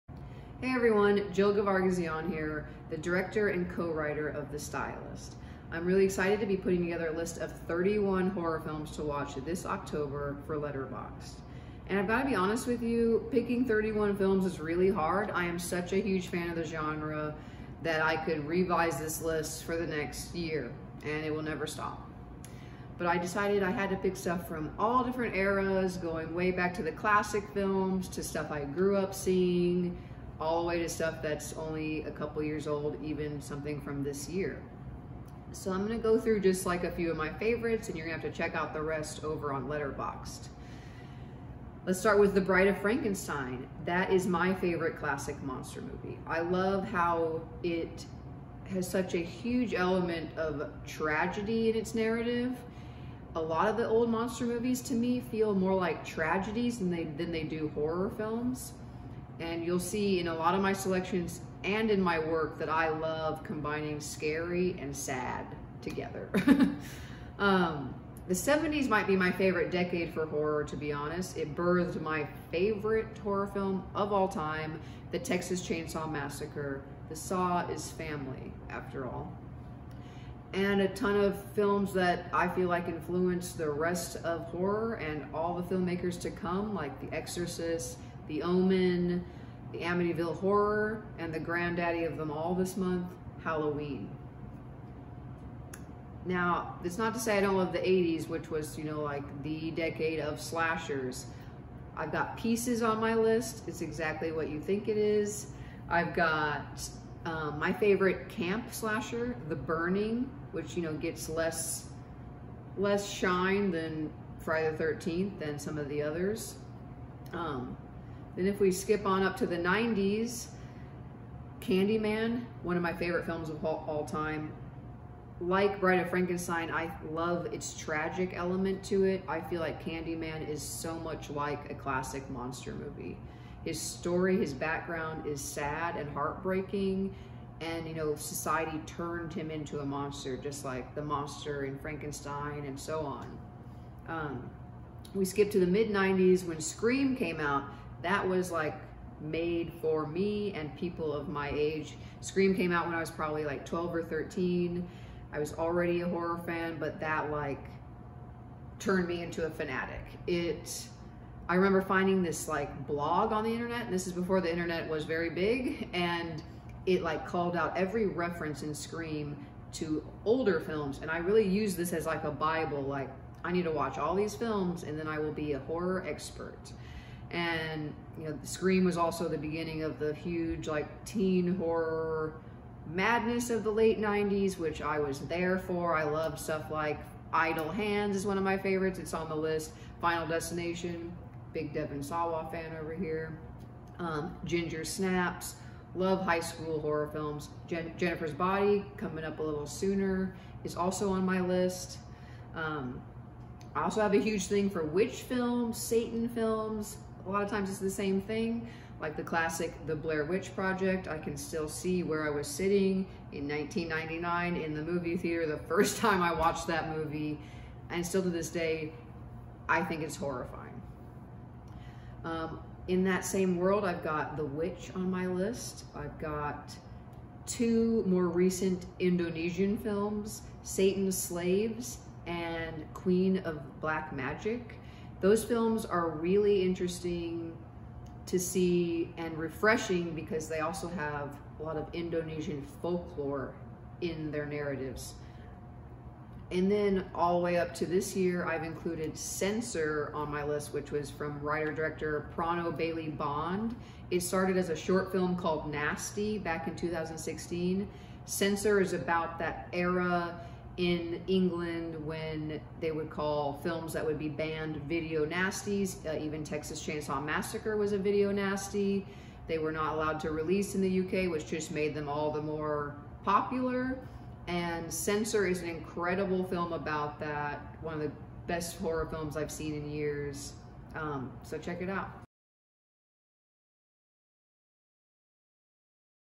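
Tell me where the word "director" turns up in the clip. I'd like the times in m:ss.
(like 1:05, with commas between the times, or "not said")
0:02, 4:11.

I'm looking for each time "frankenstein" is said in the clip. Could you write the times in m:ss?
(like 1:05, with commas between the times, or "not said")
0:42, 2:06, 2:21.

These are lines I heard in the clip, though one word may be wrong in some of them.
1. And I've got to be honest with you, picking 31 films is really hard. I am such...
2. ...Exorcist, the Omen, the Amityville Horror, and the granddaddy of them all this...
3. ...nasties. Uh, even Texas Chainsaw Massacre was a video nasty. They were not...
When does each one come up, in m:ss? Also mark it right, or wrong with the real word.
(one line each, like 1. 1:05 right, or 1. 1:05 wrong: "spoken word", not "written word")
1. 0:11 right
2. 1:27 right
3. 4:25 right.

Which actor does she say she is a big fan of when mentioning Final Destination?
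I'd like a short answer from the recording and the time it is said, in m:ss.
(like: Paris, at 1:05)
Devon Sawa, at 3:11.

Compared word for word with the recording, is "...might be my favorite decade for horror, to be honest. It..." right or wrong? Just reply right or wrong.
right.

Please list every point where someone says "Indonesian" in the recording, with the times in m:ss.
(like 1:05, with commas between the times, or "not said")
3:48, 4:01.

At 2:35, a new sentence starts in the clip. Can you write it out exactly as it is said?
I was already a horror fan, but that like turned me into a fanatic.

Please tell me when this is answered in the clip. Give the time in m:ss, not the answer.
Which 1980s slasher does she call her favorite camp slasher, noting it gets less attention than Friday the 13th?
1:49.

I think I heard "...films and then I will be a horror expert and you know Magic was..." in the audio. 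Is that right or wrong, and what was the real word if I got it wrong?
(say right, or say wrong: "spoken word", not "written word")
wrong: "Scream", not "Magic".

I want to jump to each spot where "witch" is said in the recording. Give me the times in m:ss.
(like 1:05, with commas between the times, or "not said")
3:24, 3:30, 3:44.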